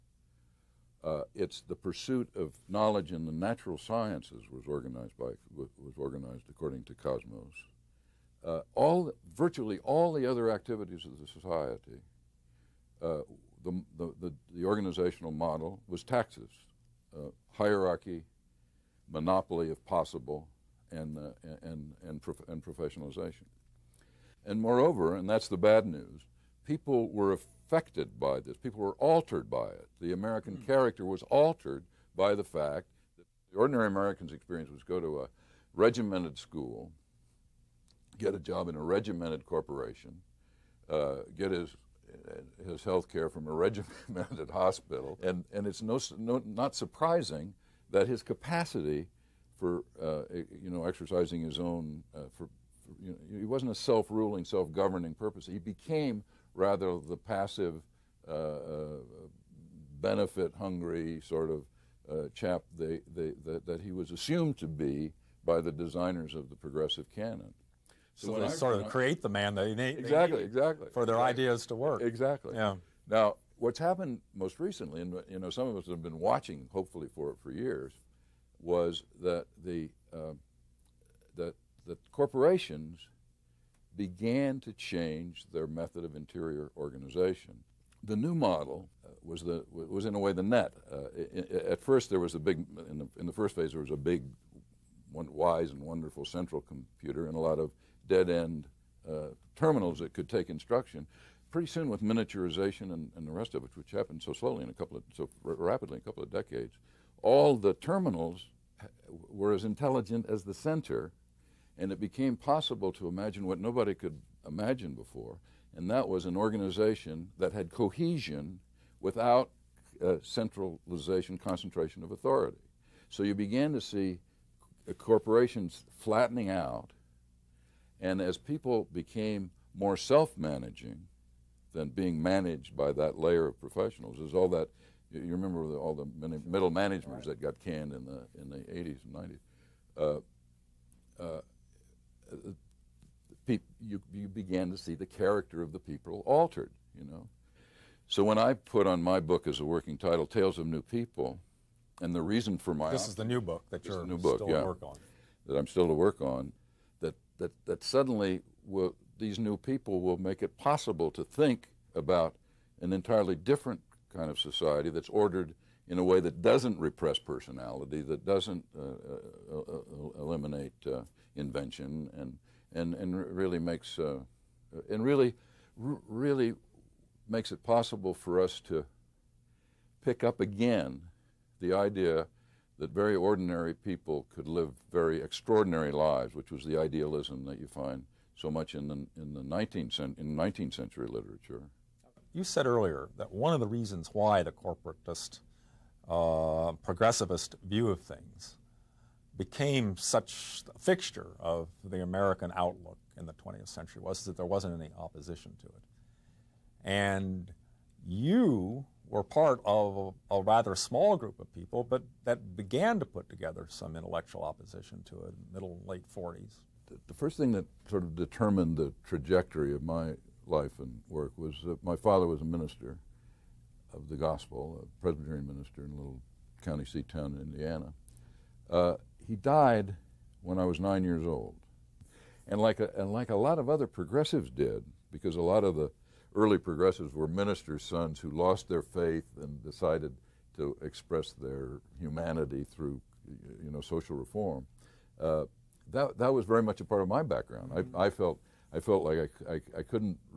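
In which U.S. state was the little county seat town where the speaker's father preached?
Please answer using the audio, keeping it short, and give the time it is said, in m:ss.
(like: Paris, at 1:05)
Indiana, at 3:47.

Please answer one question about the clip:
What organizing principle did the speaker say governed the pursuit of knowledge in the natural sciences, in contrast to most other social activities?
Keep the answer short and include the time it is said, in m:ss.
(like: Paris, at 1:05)
Cosmos, at 0:06.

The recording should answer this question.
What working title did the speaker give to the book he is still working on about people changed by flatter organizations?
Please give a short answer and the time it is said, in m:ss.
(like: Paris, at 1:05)
Tales of New People, at 2:30.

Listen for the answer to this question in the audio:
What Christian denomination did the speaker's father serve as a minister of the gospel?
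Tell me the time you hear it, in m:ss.
3:45.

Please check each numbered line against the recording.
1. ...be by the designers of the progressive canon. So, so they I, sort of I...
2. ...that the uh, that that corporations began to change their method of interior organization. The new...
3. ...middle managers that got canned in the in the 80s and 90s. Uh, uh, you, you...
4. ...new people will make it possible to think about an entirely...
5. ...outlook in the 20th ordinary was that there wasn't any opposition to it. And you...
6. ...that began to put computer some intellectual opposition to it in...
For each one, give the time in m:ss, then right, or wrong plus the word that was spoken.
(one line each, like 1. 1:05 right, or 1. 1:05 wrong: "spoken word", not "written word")
1. 1:04 right
2. 1:19 right
3. 2:16 right
4. 2:39 right
5. 3:22 wrong: "century", not "ordinary"
6. 3:32 wrong: "together", not "computer".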